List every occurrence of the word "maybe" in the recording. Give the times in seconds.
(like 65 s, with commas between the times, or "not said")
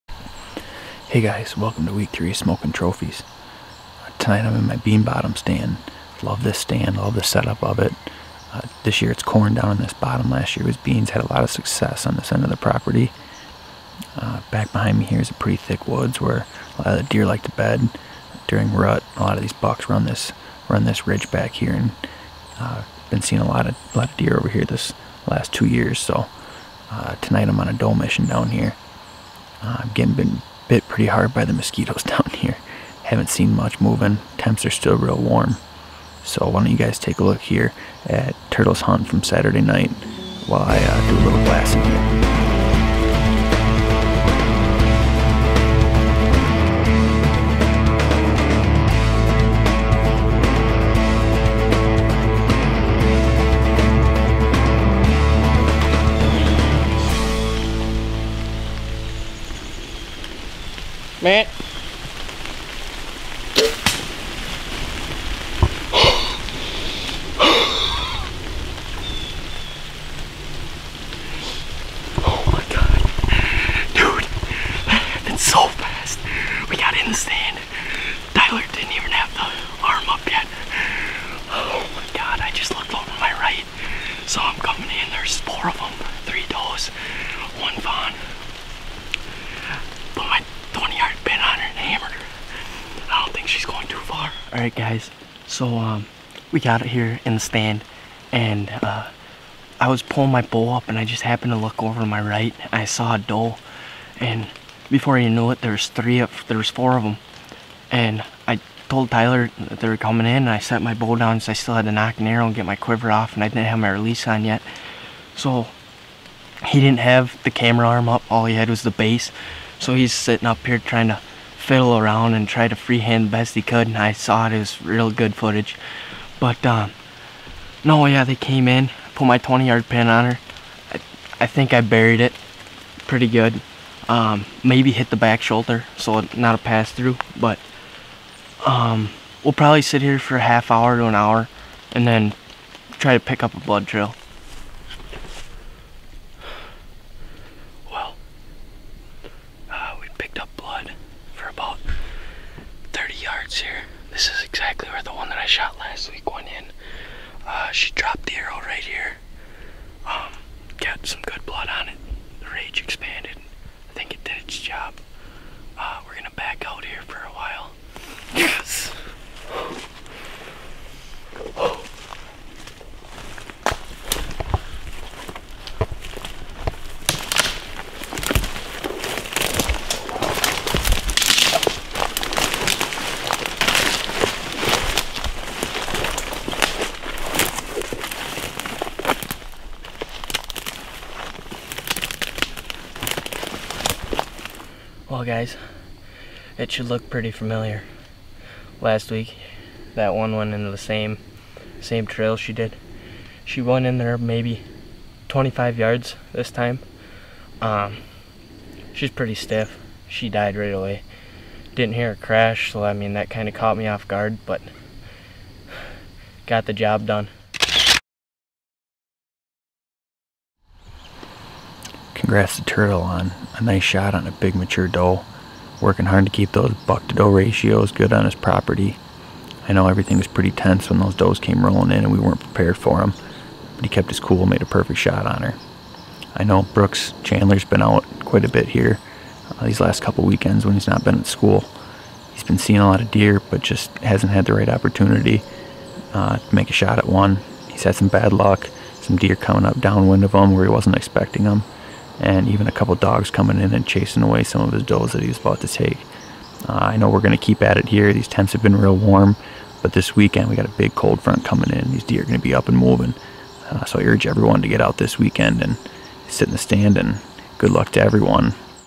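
134 s, 204 s.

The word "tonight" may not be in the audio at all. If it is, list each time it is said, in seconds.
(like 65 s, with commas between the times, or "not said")
4 s, 27 s.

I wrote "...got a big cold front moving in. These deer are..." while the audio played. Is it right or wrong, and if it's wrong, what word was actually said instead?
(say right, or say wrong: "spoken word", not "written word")
wrong: "coming", not "moving".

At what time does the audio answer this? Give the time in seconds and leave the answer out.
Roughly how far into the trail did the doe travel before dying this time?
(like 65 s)
205 s.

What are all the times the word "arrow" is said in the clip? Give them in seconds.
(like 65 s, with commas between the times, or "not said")
112 s, 158 s.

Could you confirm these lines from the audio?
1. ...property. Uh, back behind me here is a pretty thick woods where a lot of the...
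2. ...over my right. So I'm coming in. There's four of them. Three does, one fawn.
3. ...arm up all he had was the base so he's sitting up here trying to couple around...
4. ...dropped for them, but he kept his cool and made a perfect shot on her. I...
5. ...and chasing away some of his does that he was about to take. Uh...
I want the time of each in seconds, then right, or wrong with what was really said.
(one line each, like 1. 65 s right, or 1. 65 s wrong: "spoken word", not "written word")
1. 12 s right
2. 82 s right
3. 117 s wrong: "fiddle", not "couple"
4. 232 s wrong: "prepared", not "dropped"
5. 253 s right.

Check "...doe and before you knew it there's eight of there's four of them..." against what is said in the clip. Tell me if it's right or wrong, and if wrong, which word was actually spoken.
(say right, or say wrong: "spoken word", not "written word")
wrong: "three", not "eight".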